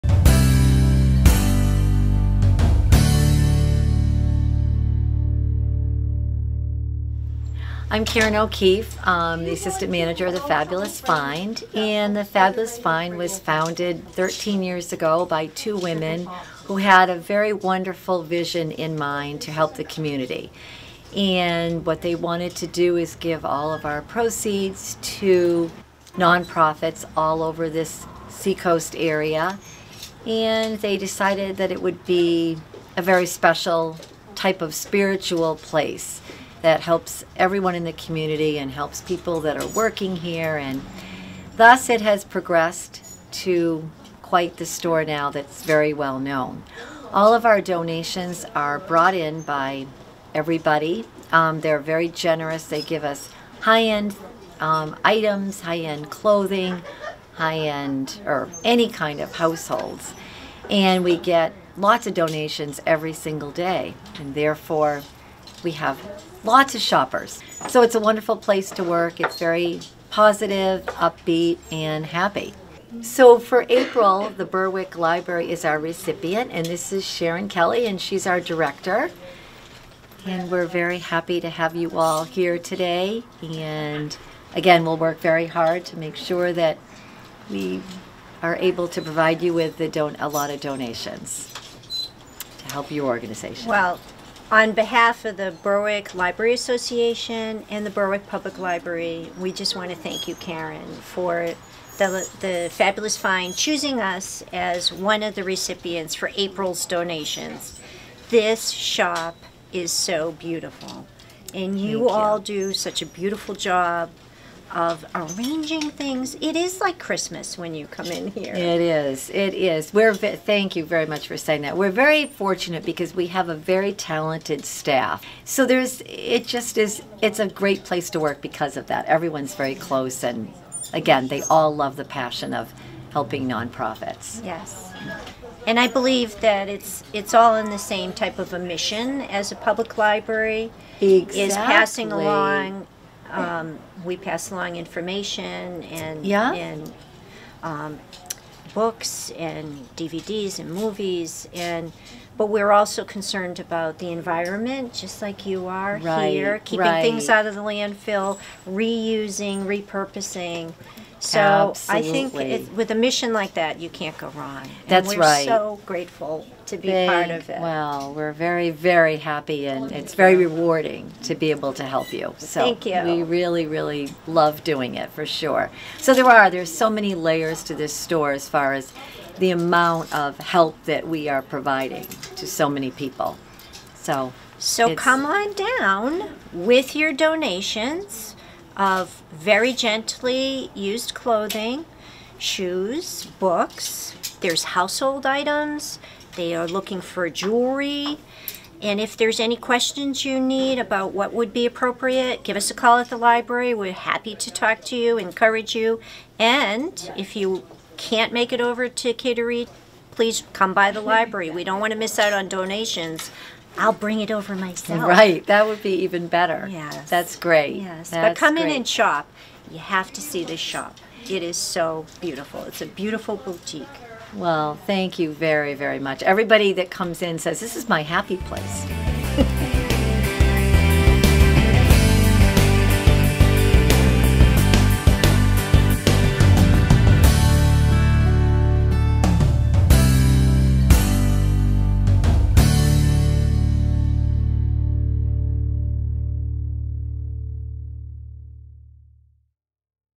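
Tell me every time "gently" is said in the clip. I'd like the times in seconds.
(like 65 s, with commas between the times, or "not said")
189 s.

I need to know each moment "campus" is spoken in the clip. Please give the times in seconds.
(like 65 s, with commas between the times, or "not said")
not said.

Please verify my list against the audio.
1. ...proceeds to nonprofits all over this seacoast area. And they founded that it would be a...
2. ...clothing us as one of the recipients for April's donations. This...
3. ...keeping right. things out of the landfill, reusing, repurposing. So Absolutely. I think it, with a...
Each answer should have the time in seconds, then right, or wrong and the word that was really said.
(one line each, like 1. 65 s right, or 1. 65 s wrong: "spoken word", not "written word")
1. 24 s wrong: "decided", not "founded"
2. 103 s wrong: "choosing", not "clothing"
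3. 156 s right.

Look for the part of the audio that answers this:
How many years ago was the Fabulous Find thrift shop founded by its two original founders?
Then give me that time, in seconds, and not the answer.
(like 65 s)
14 s.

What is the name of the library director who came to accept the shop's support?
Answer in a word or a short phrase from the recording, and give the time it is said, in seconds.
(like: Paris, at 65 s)
Sharon Kelly, at 77 s.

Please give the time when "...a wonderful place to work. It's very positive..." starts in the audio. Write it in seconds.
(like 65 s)
67 s.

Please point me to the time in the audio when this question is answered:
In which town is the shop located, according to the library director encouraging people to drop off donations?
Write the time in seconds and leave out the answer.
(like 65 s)
209 s.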